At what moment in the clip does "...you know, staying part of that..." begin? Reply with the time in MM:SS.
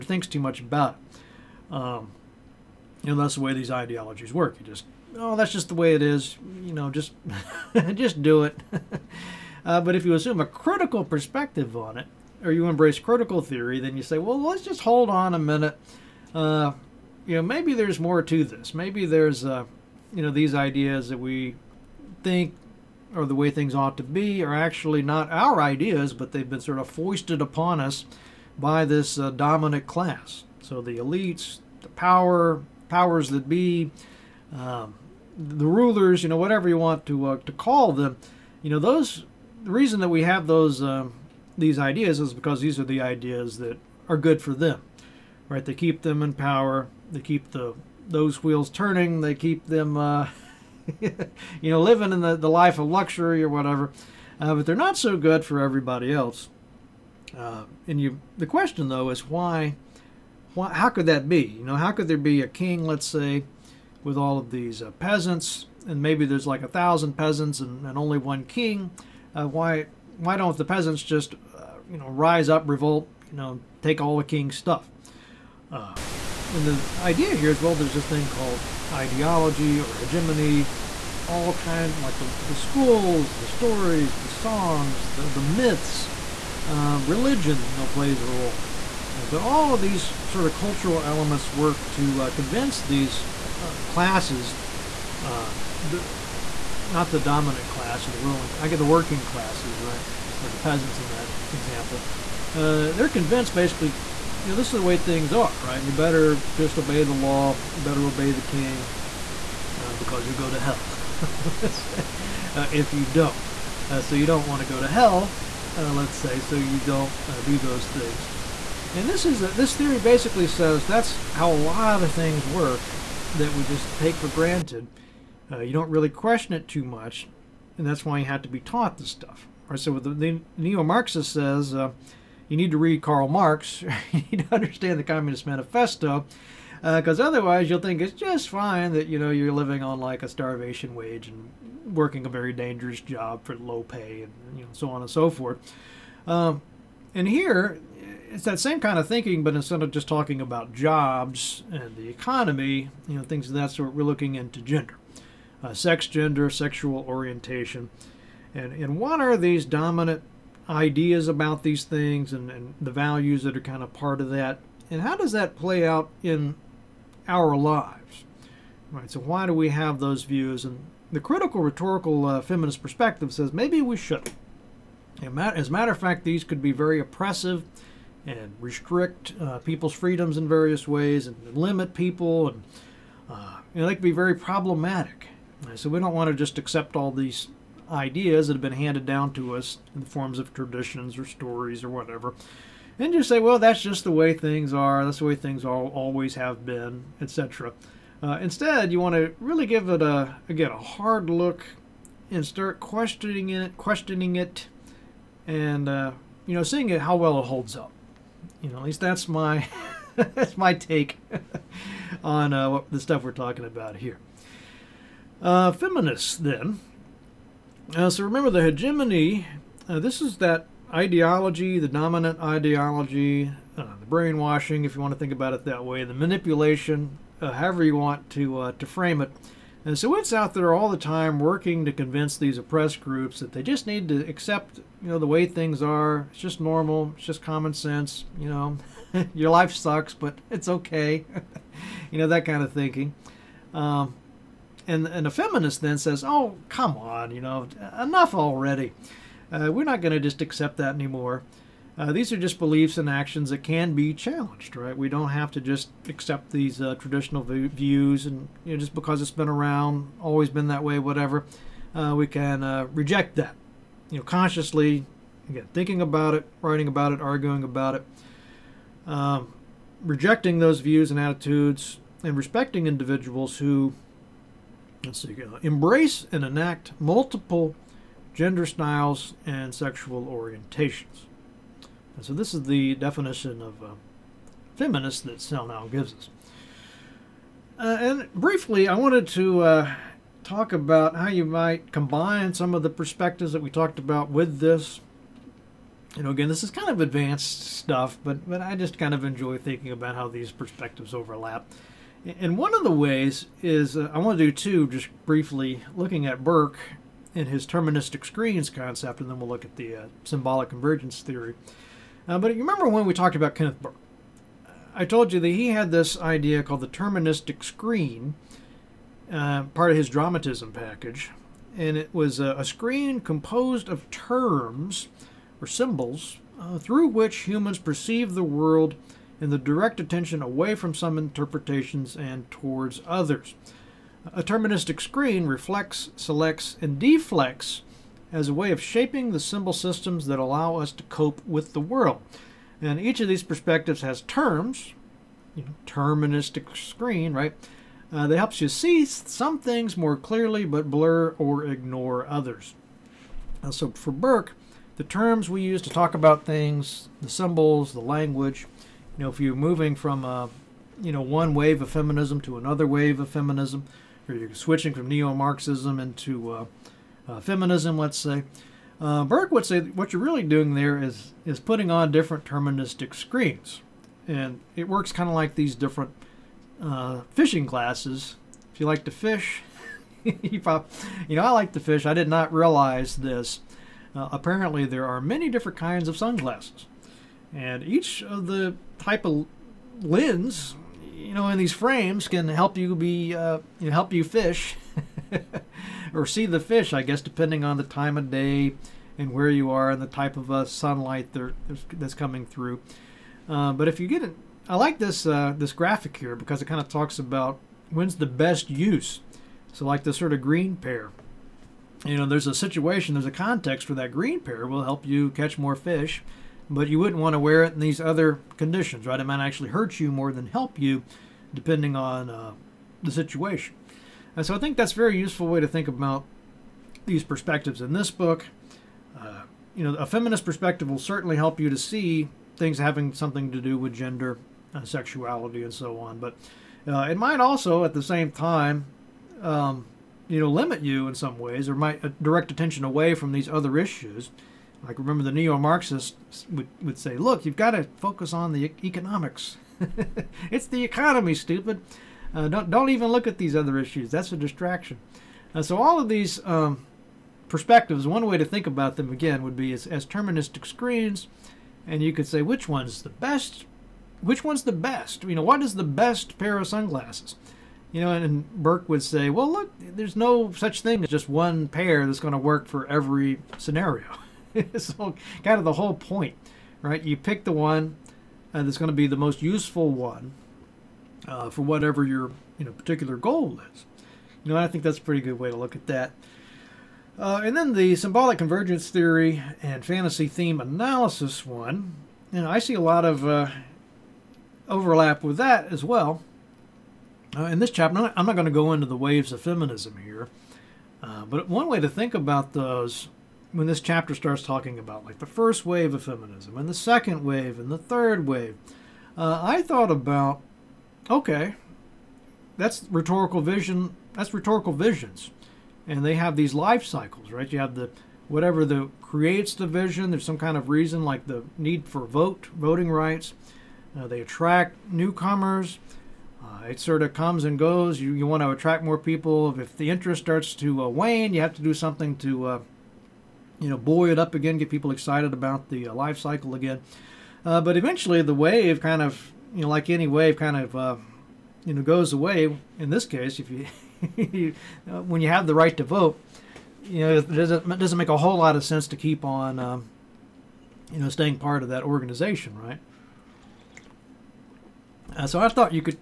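09:10.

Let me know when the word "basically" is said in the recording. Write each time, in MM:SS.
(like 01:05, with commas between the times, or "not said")
01:43, 01:59.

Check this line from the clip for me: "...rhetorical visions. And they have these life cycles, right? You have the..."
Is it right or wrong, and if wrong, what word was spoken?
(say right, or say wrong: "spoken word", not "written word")
right.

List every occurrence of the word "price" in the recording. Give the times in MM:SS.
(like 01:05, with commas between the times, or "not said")
not said.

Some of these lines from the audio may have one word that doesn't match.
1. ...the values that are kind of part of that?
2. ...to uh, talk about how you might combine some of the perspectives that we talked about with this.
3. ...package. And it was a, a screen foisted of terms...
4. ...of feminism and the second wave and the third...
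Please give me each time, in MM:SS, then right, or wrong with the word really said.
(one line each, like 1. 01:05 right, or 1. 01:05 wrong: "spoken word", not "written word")
1. 02:42 right
2. 04:49 right
3. 05:20 wrong: "composed", not "foisted"
4. 08:25 right.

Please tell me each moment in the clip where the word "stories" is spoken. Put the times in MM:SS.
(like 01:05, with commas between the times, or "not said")
01:23, 03:11.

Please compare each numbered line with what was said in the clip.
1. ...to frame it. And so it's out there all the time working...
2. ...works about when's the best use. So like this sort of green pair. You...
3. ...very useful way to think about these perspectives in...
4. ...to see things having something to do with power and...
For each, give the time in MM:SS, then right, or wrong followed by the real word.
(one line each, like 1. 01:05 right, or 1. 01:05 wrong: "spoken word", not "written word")
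1. 03:48 right
2. 06:46 wrong: "talks", not "works"
3. 07:04 right
4. 07:11 wrong: "gender", not "power".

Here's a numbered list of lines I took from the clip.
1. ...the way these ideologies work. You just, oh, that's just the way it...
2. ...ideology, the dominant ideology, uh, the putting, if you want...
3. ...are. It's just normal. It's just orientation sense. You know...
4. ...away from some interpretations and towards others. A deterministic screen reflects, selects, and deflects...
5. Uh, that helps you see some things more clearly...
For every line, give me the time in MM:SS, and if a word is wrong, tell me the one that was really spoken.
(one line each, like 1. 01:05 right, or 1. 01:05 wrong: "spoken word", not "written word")
1. 00:03 right
2. 03:40 wrong: "brainwashing", not "putting"
3. 03:55 wrong: "common", not "orientation"
4. 05:30 right
5. 05:48 right.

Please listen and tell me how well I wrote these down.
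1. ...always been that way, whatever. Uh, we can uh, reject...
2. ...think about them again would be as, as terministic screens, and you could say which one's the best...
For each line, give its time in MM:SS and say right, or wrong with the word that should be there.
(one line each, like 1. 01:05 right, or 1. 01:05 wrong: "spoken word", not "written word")
1. 04:20 right
2. 07:38 right.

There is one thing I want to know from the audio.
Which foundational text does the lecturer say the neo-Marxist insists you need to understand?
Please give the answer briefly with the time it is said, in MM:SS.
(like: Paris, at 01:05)
The Communist Manifesto, at 02:14.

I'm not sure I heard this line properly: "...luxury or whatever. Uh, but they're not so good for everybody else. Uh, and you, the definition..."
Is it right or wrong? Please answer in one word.
wrong.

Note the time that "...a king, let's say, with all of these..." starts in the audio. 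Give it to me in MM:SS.
01:02.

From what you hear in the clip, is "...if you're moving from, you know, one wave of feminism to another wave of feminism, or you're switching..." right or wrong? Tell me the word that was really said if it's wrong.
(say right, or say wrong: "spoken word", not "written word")
right.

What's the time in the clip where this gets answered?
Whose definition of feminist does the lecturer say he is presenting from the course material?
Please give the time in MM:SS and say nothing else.
04:45.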